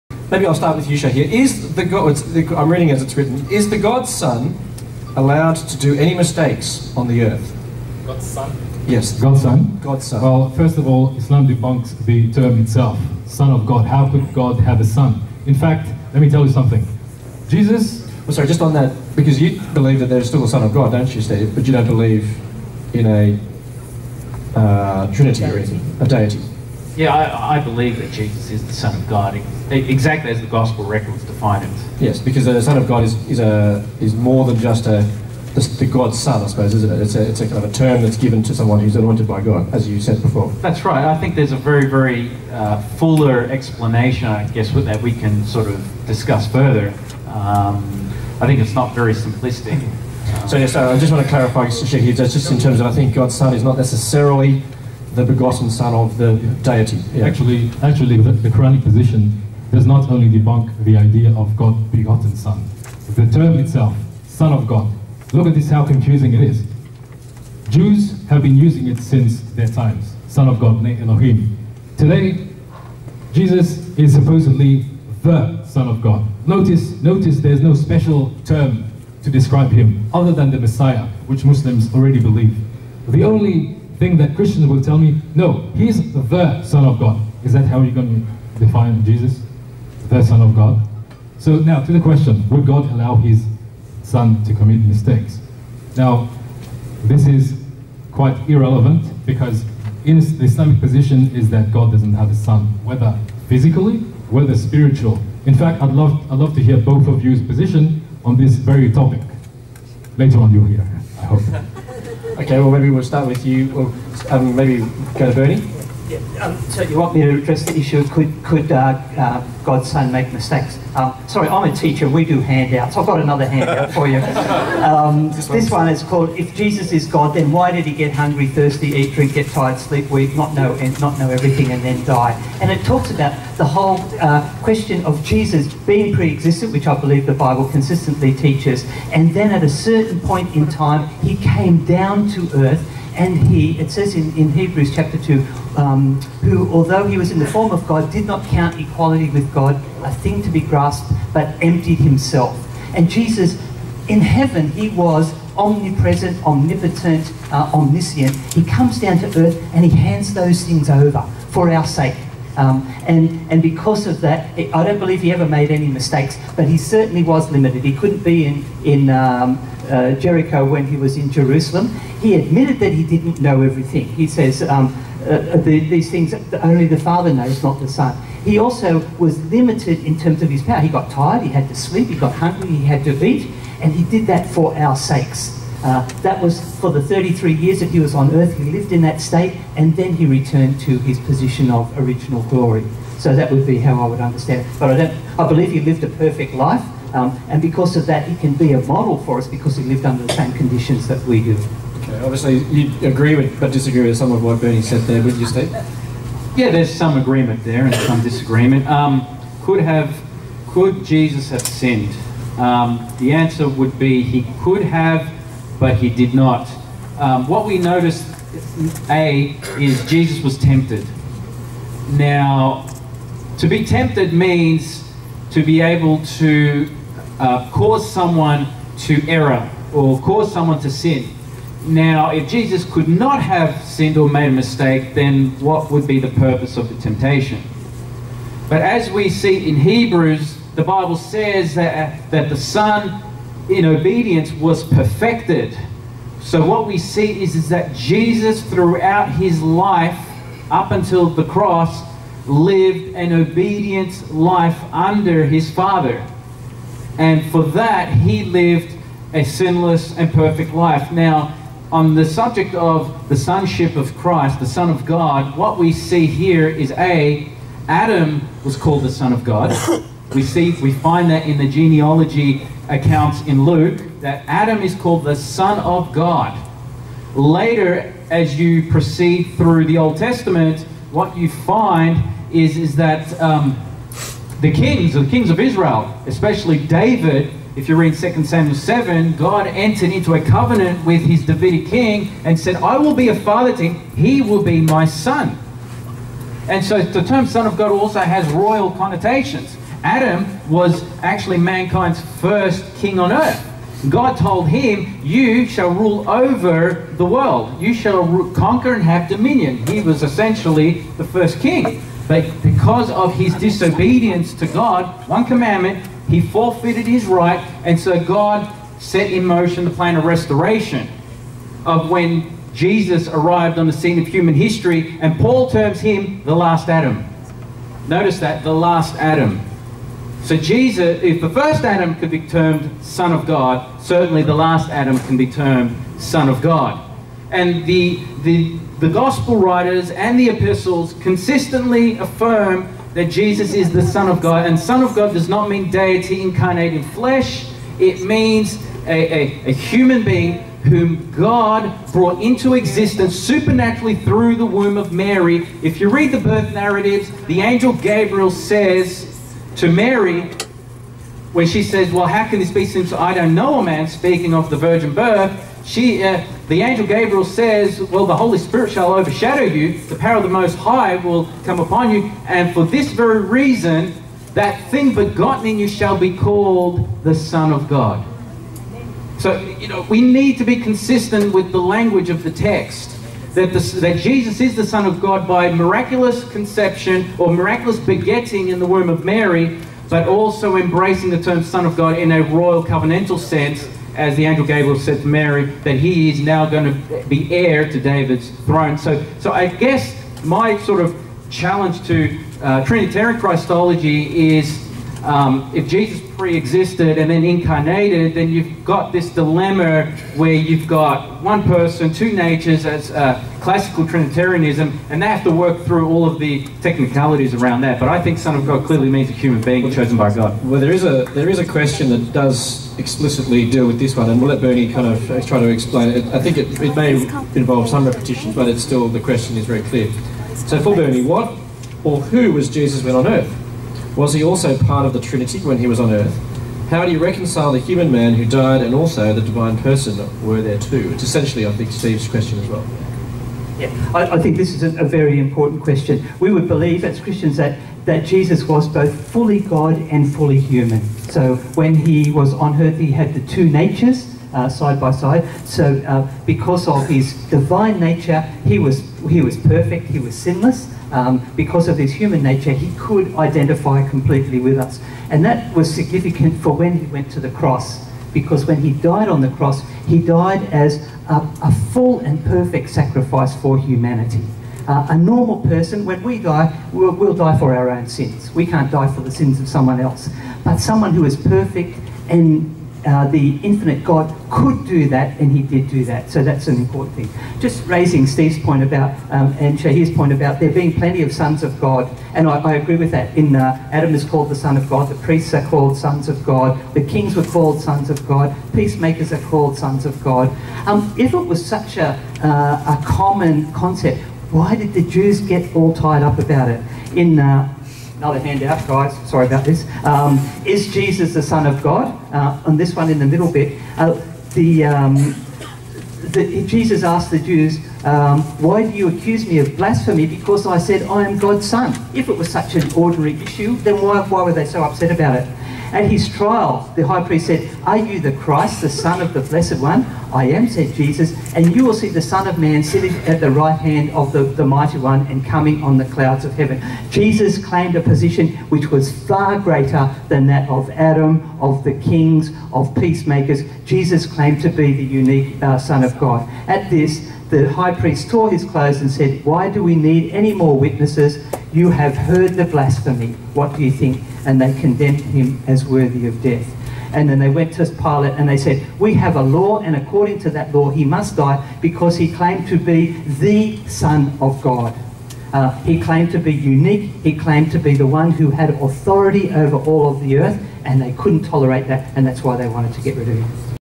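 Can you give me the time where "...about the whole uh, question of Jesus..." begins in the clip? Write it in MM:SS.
02:13.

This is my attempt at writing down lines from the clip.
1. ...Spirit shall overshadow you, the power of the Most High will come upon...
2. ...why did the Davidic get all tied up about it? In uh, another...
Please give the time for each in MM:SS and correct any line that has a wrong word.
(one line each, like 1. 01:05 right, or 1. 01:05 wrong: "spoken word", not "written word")
1. 06:08 right
2. 08:24 wrong: "Jews", not "Davidic".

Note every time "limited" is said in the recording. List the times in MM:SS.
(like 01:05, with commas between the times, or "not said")
02:47, 02:59.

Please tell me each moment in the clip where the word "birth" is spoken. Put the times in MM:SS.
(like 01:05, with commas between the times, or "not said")
05:56, 06:05.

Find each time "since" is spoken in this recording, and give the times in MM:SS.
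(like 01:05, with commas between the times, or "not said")
01:08, 06:02.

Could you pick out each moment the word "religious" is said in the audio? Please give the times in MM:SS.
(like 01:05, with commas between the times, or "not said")
not said.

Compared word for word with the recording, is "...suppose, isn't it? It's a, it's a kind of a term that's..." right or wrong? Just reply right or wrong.
right.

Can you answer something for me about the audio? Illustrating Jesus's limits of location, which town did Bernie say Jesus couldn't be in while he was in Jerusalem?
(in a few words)
Jericho.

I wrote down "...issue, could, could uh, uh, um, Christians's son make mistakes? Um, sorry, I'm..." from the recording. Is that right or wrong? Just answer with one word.
wrong.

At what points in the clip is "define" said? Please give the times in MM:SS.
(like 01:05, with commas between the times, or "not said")
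00:31, 01:28.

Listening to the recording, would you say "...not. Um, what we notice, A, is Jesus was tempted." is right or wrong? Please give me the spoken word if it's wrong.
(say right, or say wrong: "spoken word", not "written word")
right.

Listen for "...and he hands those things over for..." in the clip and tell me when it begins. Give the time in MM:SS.
02:39.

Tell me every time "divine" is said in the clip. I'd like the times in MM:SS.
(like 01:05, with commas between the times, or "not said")
07:19, 07:37.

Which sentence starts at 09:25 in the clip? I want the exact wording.
Uh, he claimed to be unique.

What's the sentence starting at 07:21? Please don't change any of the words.
It's essentially, I think, Steve's question as well.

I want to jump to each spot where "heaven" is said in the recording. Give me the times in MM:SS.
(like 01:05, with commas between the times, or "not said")
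02:34, 08:56.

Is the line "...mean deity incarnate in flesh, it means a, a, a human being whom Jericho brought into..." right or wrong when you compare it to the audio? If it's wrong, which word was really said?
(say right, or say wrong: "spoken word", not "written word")
wrong: "God", not "Jericho".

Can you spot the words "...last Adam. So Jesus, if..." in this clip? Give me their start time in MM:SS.
05:28.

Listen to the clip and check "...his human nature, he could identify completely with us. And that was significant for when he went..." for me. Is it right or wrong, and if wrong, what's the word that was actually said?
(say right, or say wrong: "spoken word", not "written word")
right.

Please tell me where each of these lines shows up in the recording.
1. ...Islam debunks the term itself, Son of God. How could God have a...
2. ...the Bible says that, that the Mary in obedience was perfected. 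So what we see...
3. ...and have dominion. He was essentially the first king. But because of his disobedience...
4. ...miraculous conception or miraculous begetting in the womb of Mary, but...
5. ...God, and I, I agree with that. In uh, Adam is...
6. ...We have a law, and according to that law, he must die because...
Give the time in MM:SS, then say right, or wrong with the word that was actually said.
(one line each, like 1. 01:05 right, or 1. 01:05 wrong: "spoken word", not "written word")
1. 00:11 right
2. 04:00 wrong: "Son", not "Mary"
3. 05:08 right
4. 06:25 right
5. 08:11 right
6. 09:18 right.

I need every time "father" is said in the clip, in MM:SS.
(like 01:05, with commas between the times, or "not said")
02:56, 04:15, 04:53.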